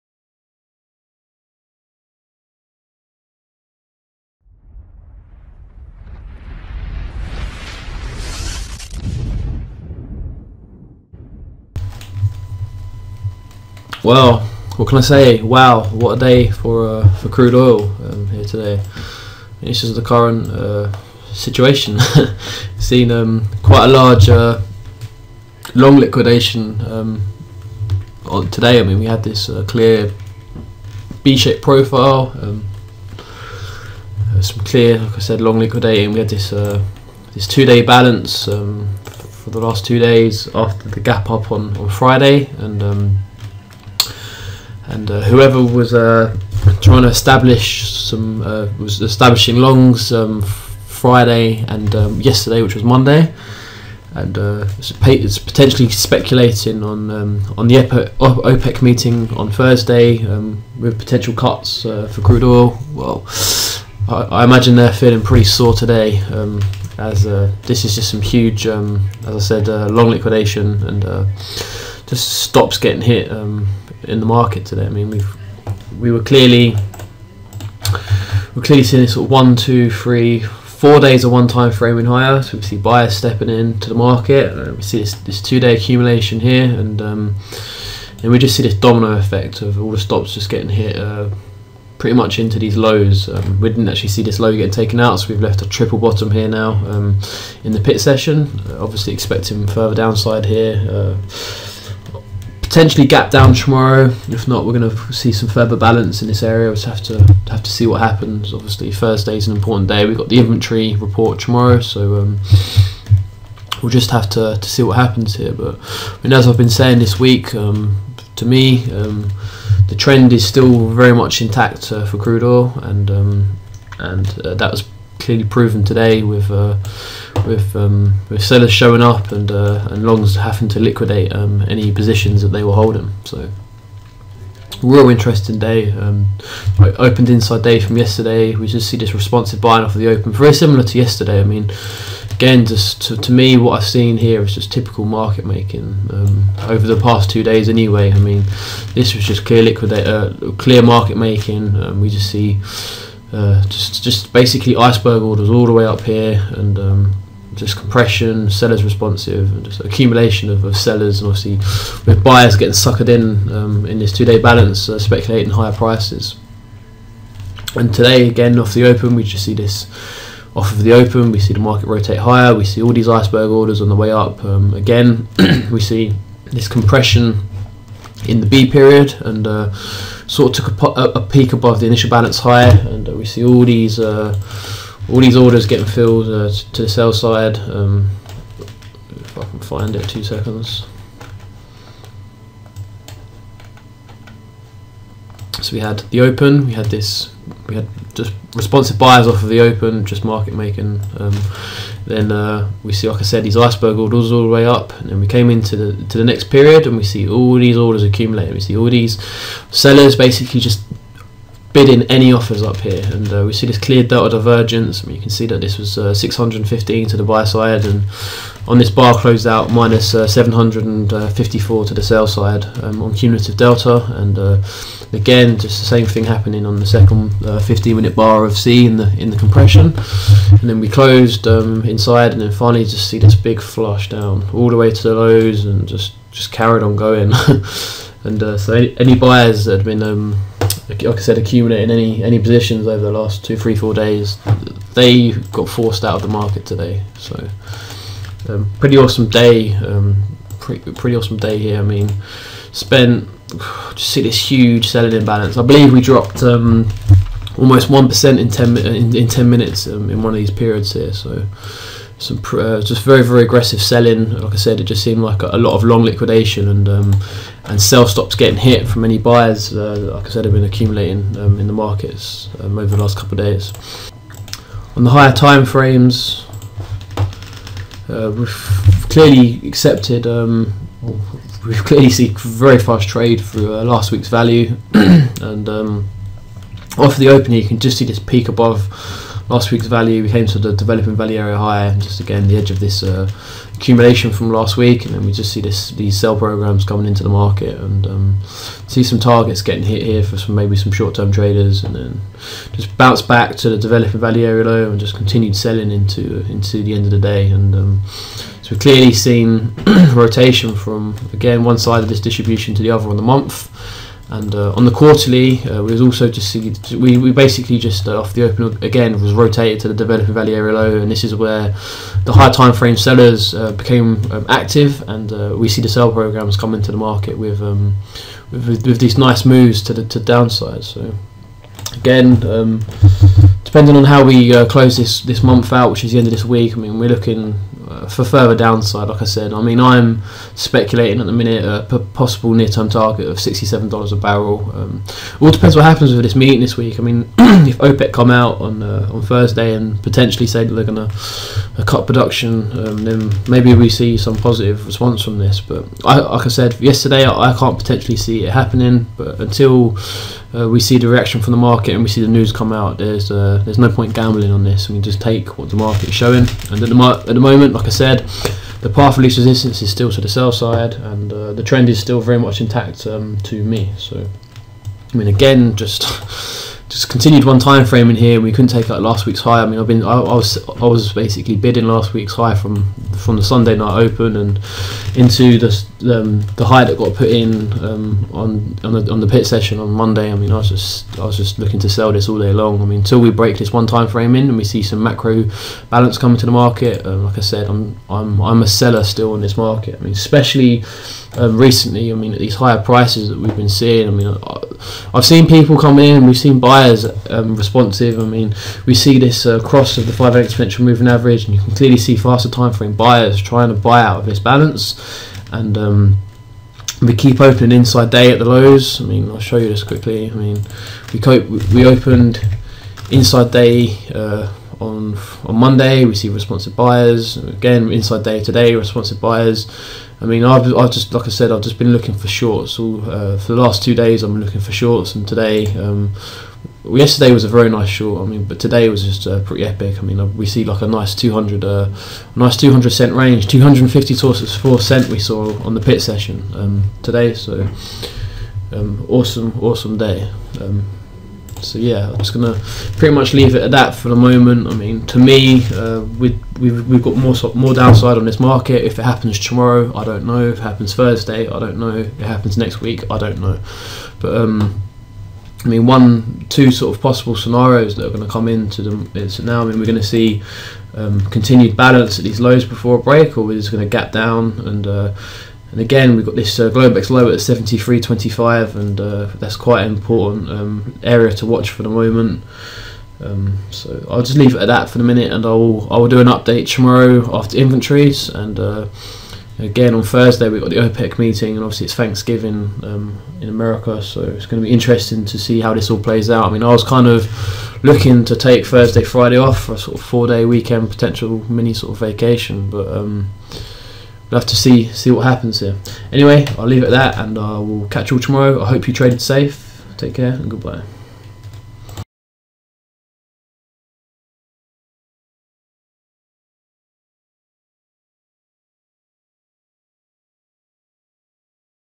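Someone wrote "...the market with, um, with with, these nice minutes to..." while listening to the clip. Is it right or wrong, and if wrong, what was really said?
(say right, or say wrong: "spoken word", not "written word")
wrong: "moves", not "minutes".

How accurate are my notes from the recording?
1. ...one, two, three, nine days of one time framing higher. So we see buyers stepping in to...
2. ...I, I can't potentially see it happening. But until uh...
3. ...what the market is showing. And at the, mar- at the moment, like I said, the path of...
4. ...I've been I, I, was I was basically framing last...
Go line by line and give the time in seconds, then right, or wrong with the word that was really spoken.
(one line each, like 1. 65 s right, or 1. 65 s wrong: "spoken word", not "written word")
1. 79 s wrong: "four", not "nine"
2. 357 s right
3. 365 s right
4. 379 s wrong: "bidding", not "framing".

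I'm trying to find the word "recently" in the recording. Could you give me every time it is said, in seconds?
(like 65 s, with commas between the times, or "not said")
401 s.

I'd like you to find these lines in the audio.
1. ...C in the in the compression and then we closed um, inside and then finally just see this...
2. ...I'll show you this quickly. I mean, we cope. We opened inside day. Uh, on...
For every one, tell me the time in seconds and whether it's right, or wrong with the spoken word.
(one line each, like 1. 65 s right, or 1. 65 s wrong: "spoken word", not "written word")
1. 228 s right
2. 419 s right.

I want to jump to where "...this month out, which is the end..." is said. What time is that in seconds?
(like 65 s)
335 s.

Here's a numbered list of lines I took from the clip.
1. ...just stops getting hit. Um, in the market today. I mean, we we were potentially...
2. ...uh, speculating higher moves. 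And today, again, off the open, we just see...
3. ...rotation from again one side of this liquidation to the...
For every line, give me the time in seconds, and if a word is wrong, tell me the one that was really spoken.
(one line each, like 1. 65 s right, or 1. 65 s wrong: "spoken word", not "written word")
1. 72 s wrong: "clearly", not "potentially"
2. 164 s wrong: "prices", not "moves"
3. 310 s wrong: "distribution", not "liquidation".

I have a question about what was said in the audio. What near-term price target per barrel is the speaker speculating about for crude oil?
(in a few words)
$67.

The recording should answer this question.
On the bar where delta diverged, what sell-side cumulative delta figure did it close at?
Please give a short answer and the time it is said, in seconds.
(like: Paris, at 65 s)
-754, at 219 s.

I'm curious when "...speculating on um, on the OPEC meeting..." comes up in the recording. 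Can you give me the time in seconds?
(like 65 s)
55 s.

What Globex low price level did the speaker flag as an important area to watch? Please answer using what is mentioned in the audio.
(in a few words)
73.25.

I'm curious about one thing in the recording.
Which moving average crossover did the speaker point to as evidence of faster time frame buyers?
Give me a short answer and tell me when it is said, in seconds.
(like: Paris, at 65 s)
5 exponential moving average, at 410 s.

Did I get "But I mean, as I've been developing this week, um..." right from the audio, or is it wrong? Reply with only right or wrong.
wrong.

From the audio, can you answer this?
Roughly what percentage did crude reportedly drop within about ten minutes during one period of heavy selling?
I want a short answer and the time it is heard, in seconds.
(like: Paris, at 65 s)
1%, at 257 s.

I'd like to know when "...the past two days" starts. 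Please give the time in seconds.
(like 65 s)
146 s.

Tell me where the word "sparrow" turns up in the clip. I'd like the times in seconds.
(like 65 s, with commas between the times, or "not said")
not said.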